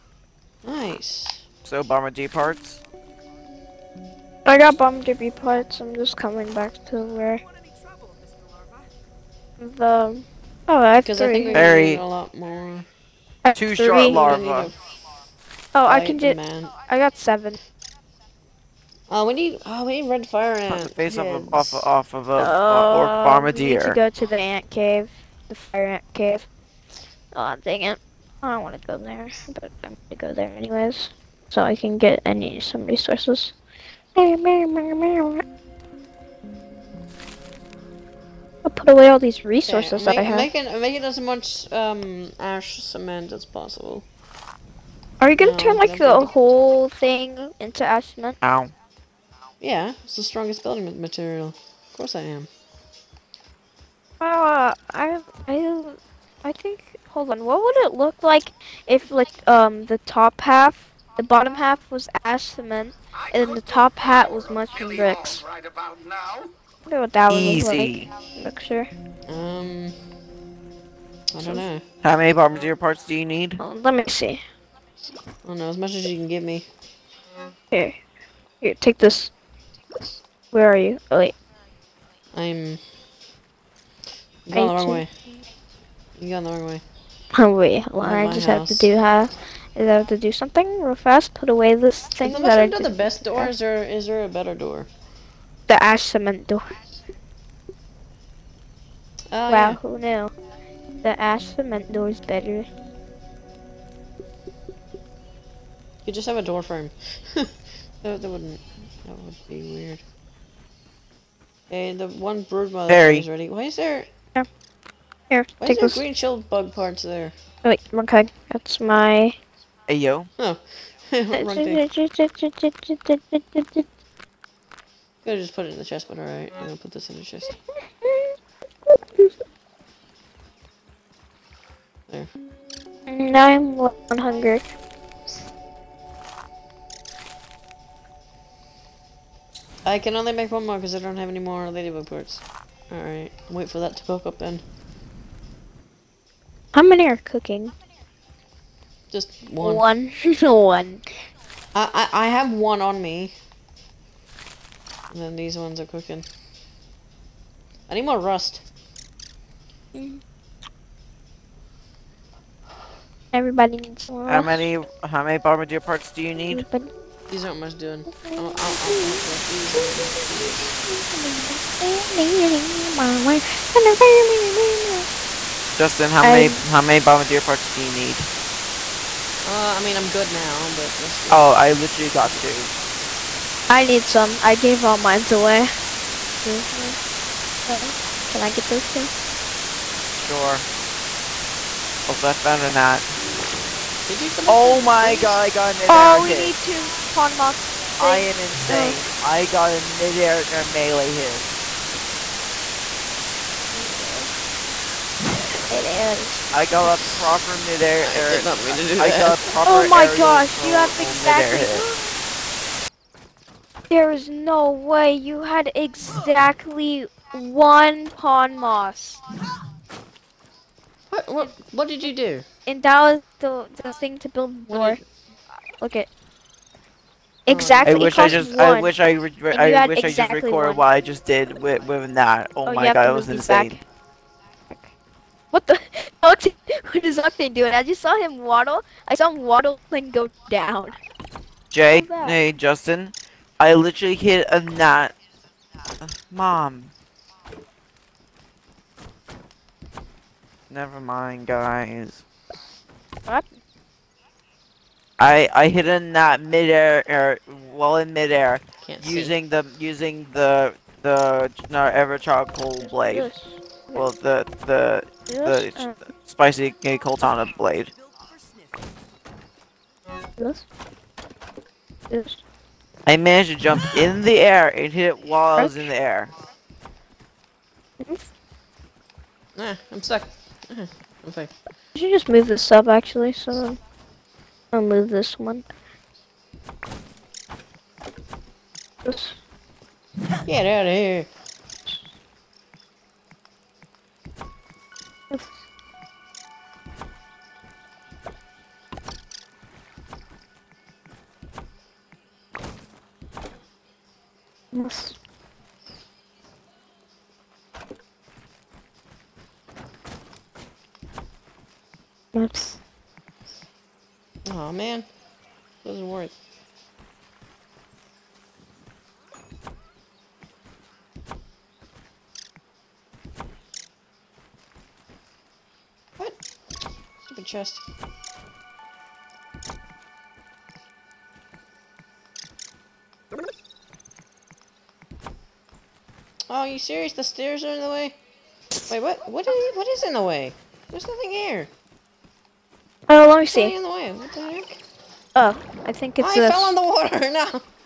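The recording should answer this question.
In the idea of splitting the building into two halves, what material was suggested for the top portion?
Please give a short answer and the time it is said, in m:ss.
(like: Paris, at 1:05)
Mushroom bricks, at 1:04.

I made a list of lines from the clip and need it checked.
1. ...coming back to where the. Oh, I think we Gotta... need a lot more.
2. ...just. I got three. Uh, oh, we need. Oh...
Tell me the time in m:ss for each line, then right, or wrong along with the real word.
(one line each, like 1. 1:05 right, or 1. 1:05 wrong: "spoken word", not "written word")
1. 0:06 wrong: "Very", not "Gotta"
2. 0:16 wrong: "seven", not "three".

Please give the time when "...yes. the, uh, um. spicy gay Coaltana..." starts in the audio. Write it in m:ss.
4:25.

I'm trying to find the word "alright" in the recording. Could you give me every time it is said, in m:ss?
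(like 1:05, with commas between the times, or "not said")
2:06, 2:22.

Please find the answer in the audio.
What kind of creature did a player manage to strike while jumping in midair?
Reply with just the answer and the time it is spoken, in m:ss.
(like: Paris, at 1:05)
A gnat, at 4:04.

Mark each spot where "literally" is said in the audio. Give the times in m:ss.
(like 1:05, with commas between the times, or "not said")
3:01, 4:03.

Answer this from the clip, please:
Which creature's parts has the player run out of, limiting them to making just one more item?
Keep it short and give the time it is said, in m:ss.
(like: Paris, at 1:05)
Ladybug, at 2:21.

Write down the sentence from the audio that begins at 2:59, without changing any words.
Uh, I mean, I'm good now, but just.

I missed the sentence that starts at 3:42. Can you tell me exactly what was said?
In Dallas, the, the thing to build more.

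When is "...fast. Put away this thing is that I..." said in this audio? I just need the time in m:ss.
1:30.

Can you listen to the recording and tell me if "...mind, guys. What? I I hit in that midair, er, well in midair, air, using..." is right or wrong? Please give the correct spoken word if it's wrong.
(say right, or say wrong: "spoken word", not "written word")
right.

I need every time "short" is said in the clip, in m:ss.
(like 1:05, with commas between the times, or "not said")
0:13.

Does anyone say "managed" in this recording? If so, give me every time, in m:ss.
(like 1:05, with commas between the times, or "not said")
4:33.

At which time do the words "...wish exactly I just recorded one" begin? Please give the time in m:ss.
3:49.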